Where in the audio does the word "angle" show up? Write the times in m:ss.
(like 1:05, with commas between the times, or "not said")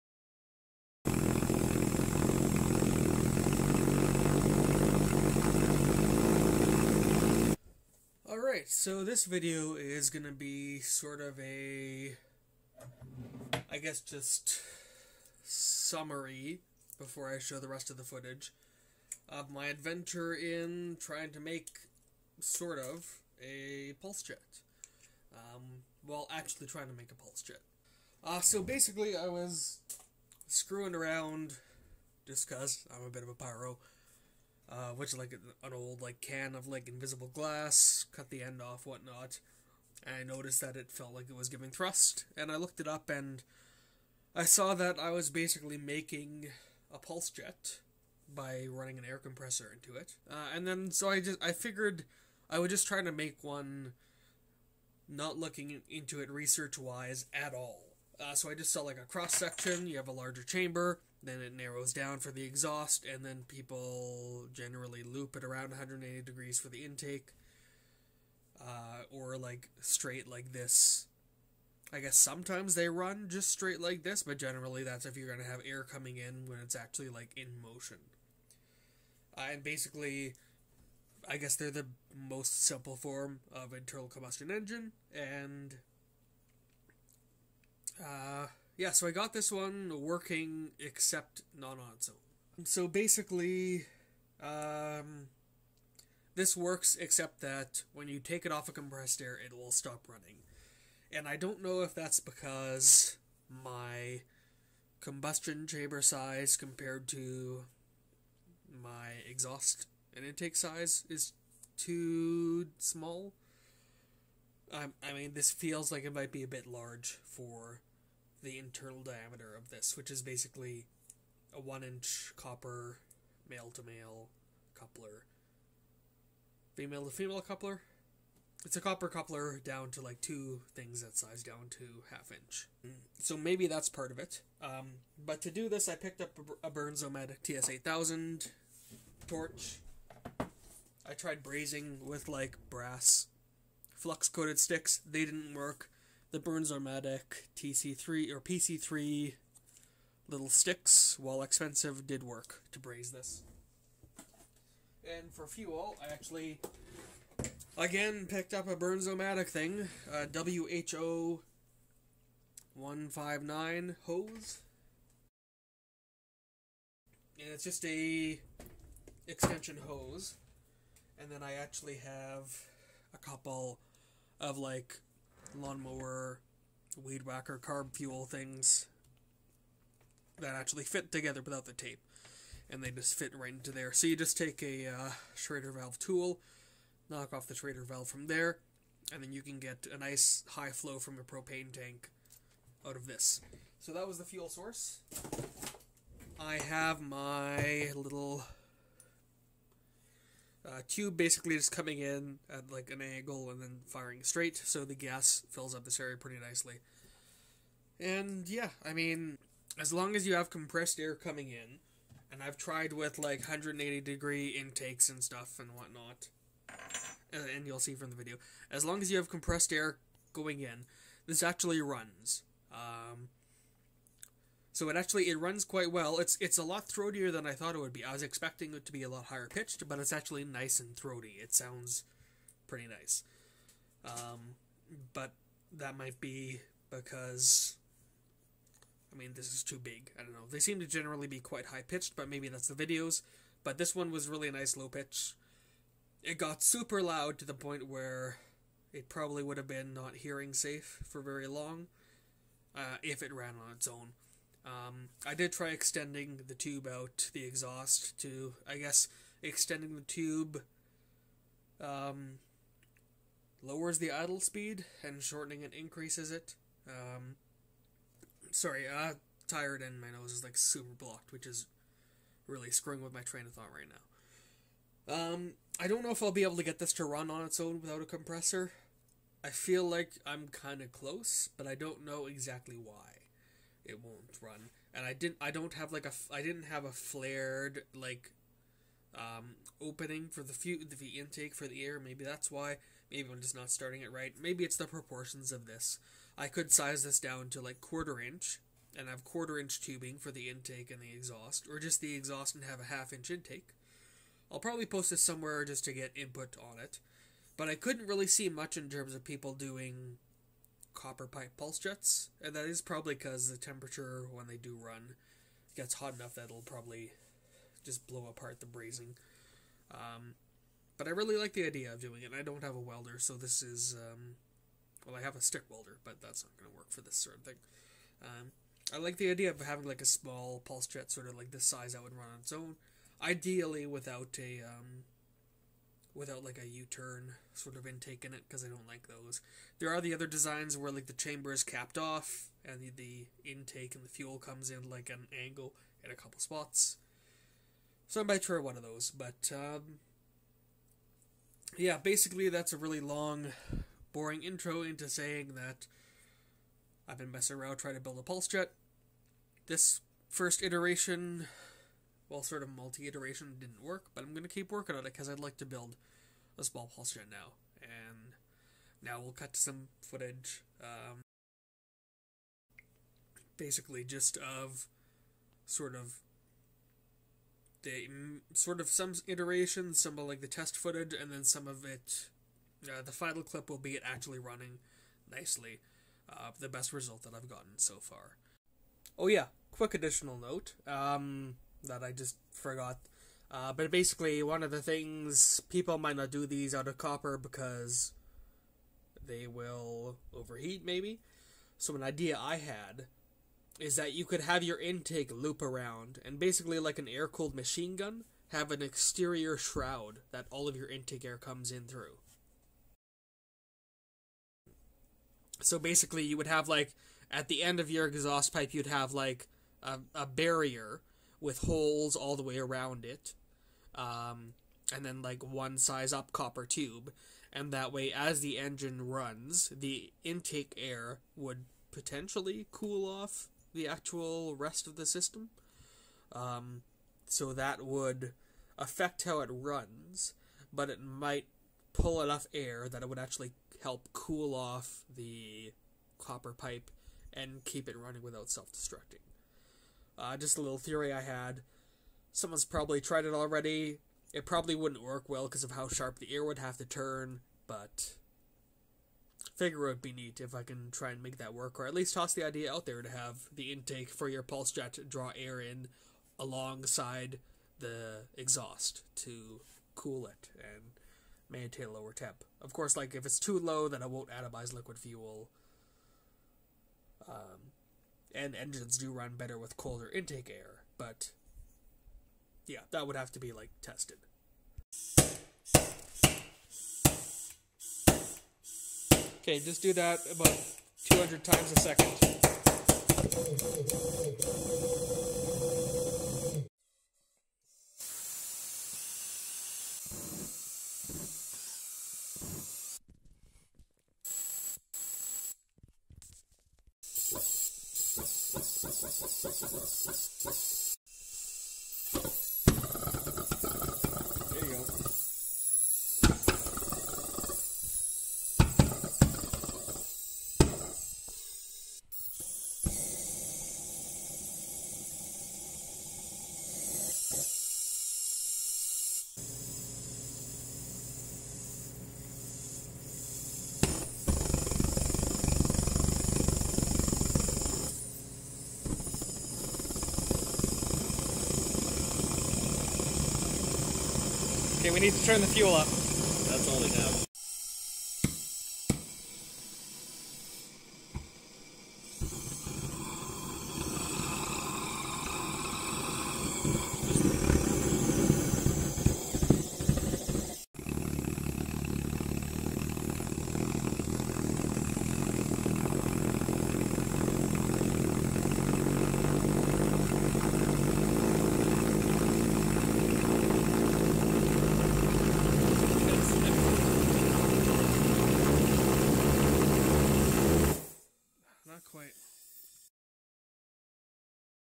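3:23, 5:45.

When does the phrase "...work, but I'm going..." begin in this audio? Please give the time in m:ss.
6:03.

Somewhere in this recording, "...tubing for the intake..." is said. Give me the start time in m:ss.
4:59.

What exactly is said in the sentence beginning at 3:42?
Um, so it actually it runs quite well.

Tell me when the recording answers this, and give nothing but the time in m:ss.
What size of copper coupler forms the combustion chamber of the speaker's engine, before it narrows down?
2:01.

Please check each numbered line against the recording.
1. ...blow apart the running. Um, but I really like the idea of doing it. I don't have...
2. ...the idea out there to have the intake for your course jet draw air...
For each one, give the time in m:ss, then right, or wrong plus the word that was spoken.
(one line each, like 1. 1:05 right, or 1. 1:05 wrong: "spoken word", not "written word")
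1. 5:18 wrong: "brazing", not "running"
2. 7:42 wrong: "pulse", not "course".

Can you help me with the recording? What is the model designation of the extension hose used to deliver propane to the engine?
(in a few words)
WHO 159.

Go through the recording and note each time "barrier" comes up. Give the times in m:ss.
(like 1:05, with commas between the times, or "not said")
7:00.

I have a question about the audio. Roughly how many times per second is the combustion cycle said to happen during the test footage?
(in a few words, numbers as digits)
200.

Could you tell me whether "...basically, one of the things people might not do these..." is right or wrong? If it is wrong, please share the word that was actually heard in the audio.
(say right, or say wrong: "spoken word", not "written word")
right.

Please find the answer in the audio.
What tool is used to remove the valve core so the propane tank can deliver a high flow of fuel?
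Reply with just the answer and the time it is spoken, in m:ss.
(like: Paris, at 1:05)
Schrader valve tool, at 3:05.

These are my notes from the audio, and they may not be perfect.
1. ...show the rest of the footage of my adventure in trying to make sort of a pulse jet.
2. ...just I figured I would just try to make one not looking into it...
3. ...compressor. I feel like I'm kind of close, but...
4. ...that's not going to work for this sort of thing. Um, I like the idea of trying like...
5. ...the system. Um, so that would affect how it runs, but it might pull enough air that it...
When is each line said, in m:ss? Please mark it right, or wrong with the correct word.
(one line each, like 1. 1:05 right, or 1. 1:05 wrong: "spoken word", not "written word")
1. 0:17 right
2. 0:51 right
3. 4:38 right
4. 5:26 wrong: "having", not "trying"
5. 7:14 right.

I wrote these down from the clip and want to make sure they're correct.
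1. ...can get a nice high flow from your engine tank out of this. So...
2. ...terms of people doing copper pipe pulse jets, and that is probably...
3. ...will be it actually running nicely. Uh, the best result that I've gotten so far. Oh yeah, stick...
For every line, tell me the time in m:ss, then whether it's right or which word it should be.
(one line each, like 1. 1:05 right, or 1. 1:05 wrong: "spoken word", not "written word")
1. 3:09 wrong: "propane", not "engine"
2. 5:08 right
3. 6:23 wrong: "quick", not "stick".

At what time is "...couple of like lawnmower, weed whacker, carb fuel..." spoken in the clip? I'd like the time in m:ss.
2:53.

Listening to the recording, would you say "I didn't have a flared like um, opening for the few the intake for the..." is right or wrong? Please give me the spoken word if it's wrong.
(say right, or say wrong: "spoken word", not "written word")
right.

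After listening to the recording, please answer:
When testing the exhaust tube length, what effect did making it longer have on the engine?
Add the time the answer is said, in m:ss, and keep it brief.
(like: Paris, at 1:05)
Lowers the idle speed, at 4:23.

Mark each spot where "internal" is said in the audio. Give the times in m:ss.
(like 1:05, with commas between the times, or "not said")
1:23, 1:58.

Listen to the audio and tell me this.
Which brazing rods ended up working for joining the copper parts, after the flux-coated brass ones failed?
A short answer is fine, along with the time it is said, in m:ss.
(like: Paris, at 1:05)
Bernzomatic PC3, at 2:28.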